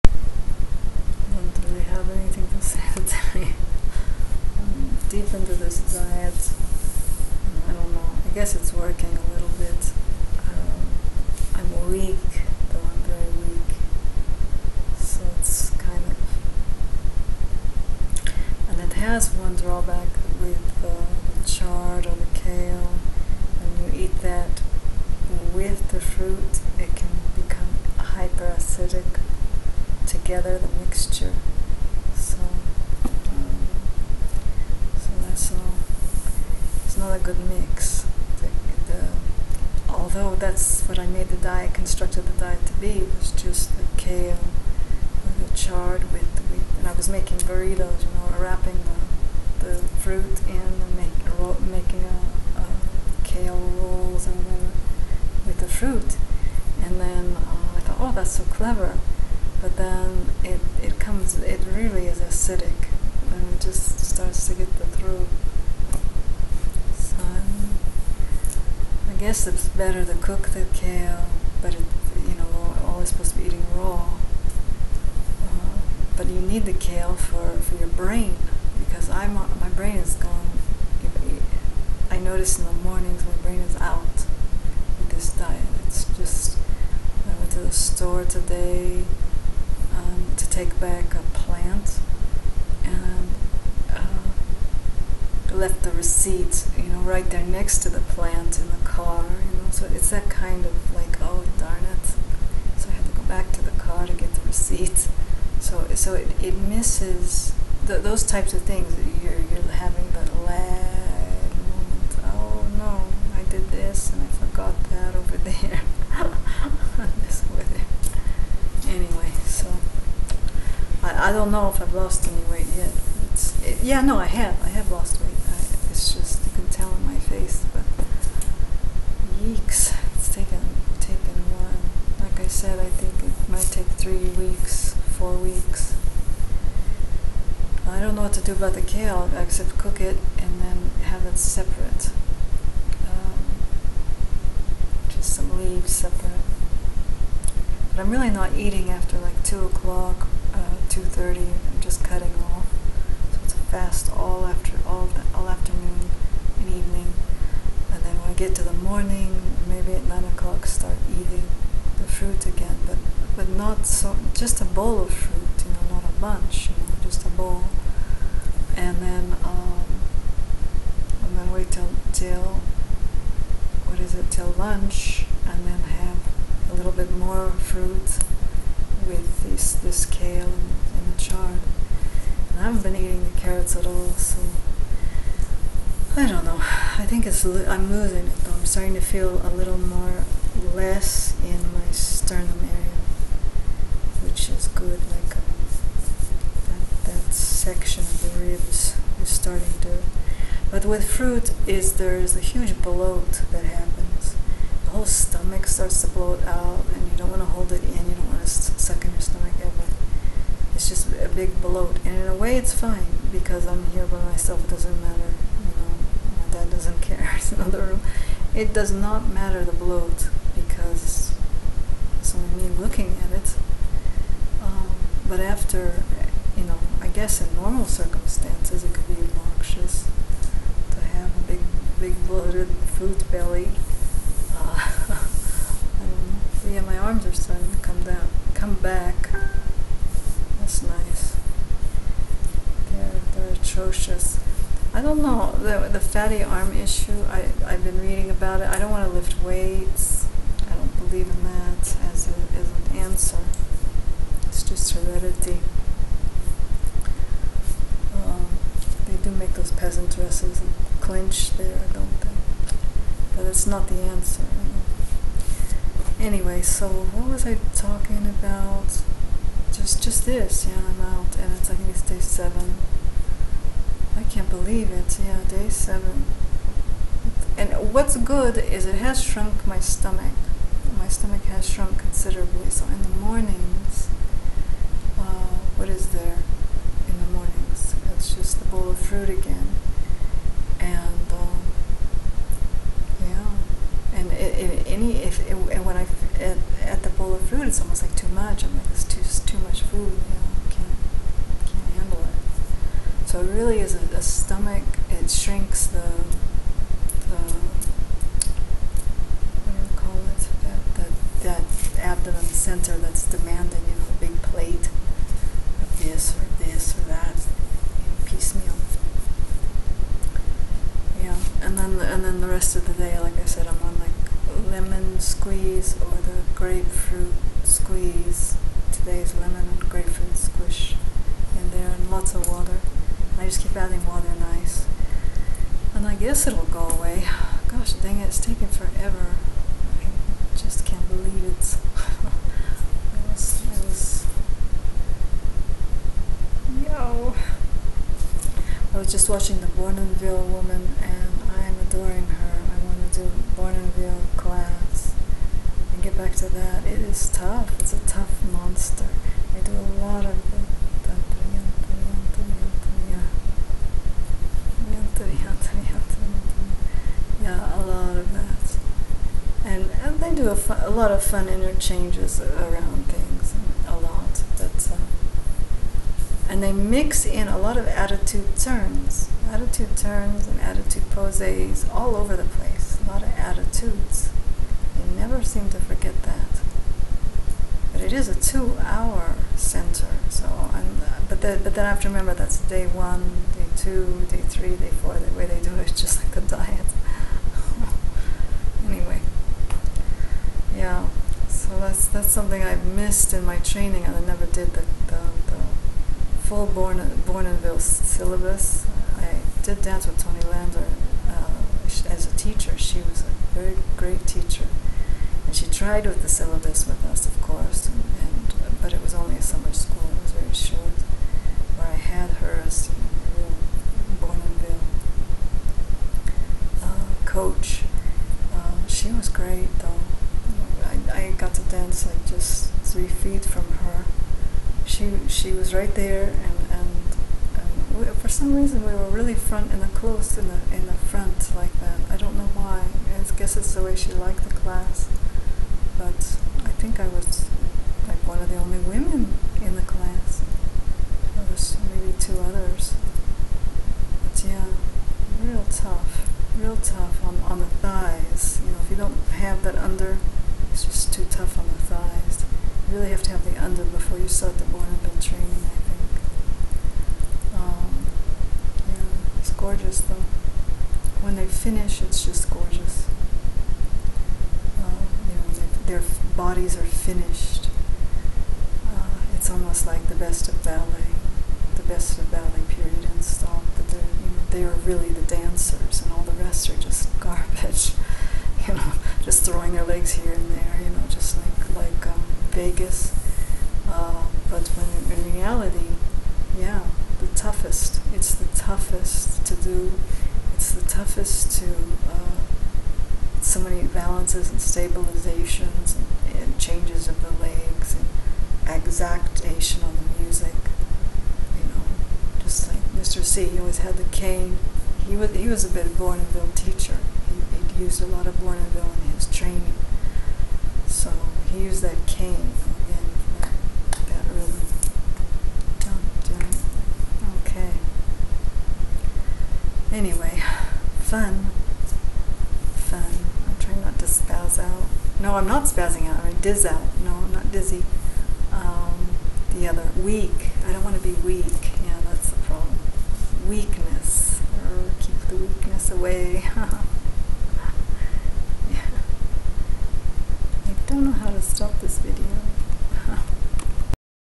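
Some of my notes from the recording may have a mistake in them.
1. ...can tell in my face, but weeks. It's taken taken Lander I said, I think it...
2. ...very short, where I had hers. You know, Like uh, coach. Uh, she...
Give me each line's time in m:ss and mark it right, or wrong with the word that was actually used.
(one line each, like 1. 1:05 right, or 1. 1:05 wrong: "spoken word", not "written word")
1. 2:06 wrong: "Like", not "Lander"
2. 7:00 wrong: "Bournonville", not "Like".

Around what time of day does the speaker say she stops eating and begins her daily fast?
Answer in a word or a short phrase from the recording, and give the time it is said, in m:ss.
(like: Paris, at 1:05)
2:30, at 2:30.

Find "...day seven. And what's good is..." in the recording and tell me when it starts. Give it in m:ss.
4:35.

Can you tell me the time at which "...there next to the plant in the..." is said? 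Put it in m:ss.
1:37.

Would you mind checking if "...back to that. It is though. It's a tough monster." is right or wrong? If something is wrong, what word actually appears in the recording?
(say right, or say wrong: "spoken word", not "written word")
wrong: "tough", not "though".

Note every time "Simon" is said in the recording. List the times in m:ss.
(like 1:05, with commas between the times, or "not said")
not said.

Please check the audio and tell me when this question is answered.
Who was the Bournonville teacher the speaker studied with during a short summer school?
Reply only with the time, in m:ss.
6:50.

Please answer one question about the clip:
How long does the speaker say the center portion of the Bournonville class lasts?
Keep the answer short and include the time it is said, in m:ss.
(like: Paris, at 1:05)
two-hour, at 6:28.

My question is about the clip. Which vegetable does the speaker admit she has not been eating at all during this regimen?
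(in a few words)
carrots.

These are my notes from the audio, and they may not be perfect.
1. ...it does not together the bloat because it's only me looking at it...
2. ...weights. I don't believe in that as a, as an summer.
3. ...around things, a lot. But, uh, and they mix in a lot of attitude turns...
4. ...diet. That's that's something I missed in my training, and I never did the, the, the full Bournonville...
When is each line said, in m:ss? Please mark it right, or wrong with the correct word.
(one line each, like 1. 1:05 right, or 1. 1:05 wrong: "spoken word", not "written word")
1. 3:38 wrong: "matter", not "together"
2. 4:09 wrong: "answer", not "summer"
3. 6:12 right
4. 6:36 wrong: "Born", not "Bournonville".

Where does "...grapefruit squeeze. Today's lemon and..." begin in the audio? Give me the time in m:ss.
5:26.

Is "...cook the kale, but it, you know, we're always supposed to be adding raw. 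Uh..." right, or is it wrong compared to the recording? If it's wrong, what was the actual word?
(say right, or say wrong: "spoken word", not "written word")
wrong: "eating", not "adding".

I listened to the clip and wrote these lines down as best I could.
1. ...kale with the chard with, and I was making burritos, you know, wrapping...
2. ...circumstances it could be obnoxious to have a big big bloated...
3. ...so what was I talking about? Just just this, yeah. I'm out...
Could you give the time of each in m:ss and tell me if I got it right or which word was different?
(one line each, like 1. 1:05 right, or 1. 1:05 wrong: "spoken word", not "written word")
1. 0:43 right
2. 3:47 right
3. 4:26 right.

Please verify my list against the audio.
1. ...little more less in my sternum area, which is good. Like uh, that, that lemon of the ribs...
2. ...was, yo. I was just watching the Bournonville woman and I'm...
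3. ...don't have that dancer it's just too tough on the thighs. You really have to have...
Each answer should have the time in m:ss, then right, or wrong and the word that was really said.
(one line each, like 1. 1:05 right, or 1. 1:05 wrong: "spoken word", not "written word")
1. 3:09 wrong: "section", not "lemon"
2. 5:43 right
3. 7:38 wrong: "under", not "dancer".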